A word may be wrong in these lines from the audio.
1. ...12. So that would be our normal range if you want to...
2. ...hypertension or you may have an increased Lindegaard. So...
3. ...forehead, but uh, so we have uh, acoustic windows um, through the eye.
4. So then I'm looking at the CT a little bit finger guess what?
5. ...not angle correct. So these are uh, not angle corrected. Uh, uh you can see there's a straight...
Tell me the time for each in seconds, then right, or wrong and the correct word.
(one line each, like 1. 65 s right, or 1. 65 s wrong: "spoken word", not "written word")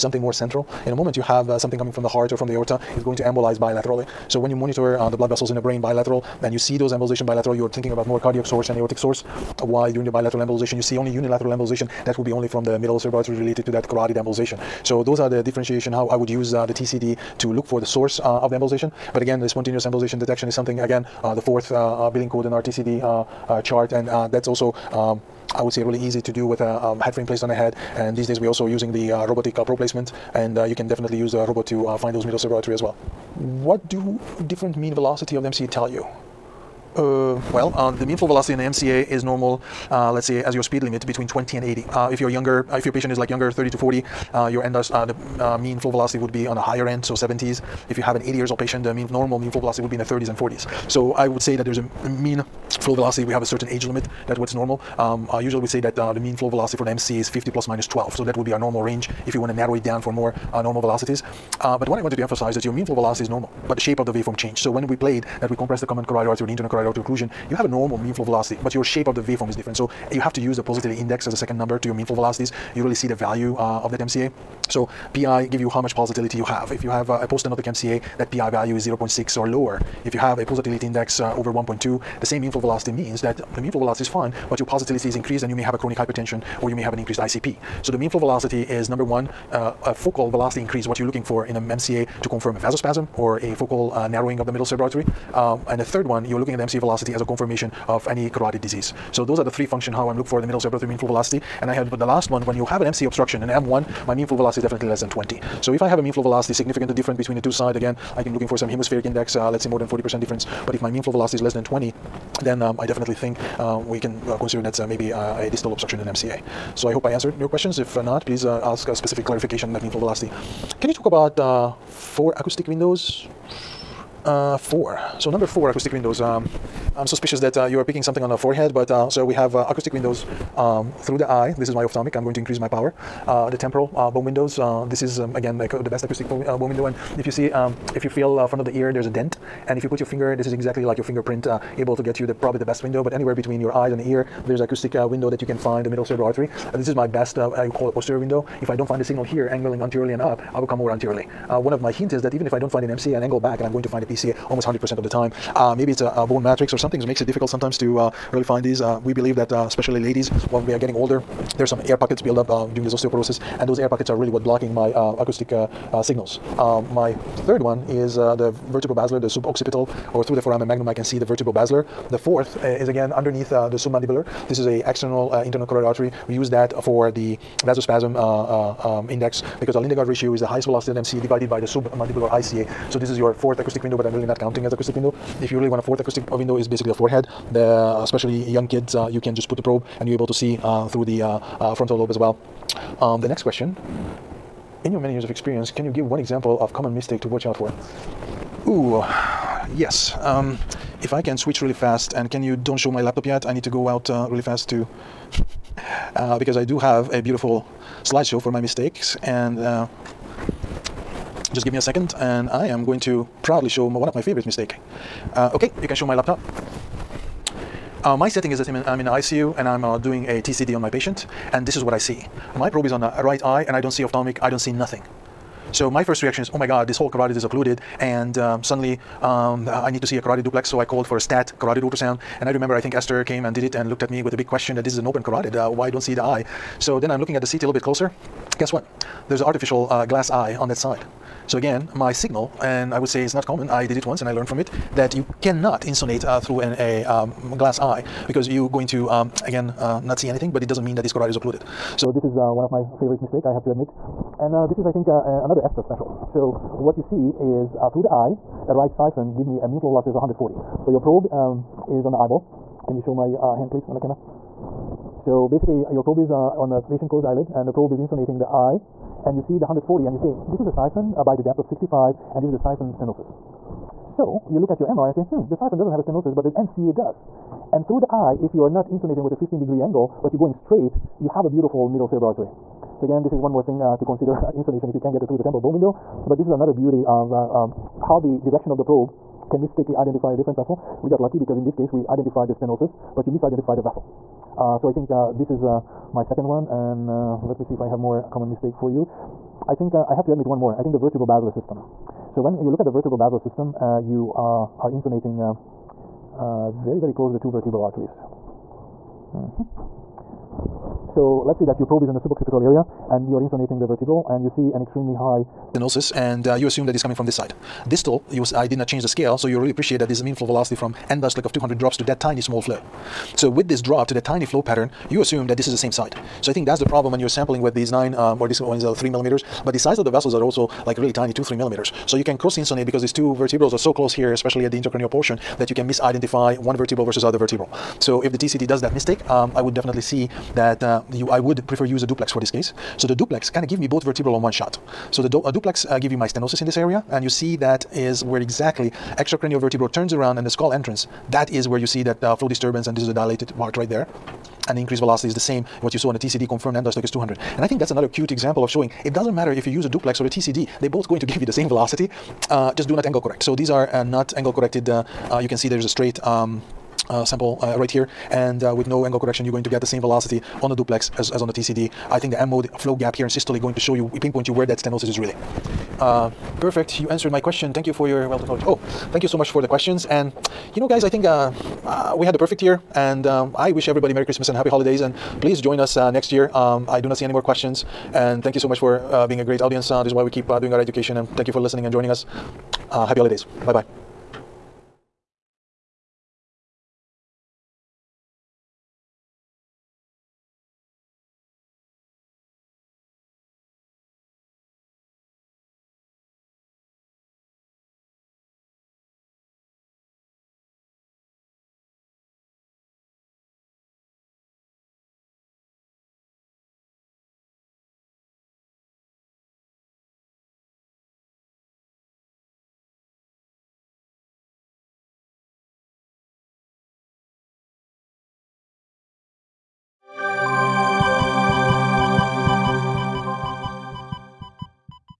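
1. 57 s right
2. 85 s wrong: "ICP", not "Lindegaard"
3. 128 s right
4. 236 s wrong: "closer", not "finger"
5. 362 s right.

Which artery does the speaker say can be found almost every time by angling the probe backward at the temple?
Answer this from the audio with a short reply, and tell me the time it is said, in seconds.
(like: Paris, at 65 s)
PCA, at 154 s.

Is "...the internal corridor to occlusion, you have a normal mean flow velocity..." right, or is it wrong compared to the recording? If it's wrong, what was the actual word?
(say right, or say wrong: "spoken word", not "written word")
right.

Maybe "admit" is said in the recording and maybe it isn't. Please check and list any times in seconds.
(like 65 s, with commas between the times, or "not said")
253 s, 300 s.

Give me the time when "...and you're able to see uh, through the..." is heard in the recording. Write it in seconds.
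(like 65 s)
190 s.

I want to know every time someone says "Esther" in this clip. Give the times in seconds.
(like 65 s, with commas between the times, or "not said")
232 s, 255 s.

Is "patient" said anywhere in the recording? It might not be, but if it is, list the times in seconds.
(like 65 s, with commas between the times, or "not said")
42 s, 48 s, 220 s, 266 s.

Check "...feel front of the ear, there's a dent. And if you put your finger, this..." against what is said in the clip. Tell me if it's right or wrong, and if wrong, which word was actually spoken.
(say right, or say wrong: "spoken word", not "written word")
right.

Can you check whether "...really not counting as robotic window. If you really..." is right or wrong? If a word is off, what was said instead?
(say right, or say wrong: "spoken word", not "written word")
wrong: "acoustic", not "robotic".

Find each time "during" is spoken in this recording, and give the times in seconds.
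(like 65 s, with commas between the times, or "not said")
9 s, 162 s.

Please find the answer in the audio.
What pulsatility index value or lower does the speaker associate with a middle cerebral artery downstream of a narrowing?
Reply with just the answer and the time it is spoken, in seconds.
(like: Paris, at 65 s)
0.6, at 78 s.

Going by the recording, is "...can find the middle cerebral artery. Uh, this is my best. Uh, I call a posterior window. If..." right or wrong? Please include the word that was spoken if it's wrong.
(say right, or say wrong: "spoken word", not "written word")
right.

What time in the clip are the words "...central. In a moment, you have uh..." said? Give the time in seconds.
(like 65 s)
0 s.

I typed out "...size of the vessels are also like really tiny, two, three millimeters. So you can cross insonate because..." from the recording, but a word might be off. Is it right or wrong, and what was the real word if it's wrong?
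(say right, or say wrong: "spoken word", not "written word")
right.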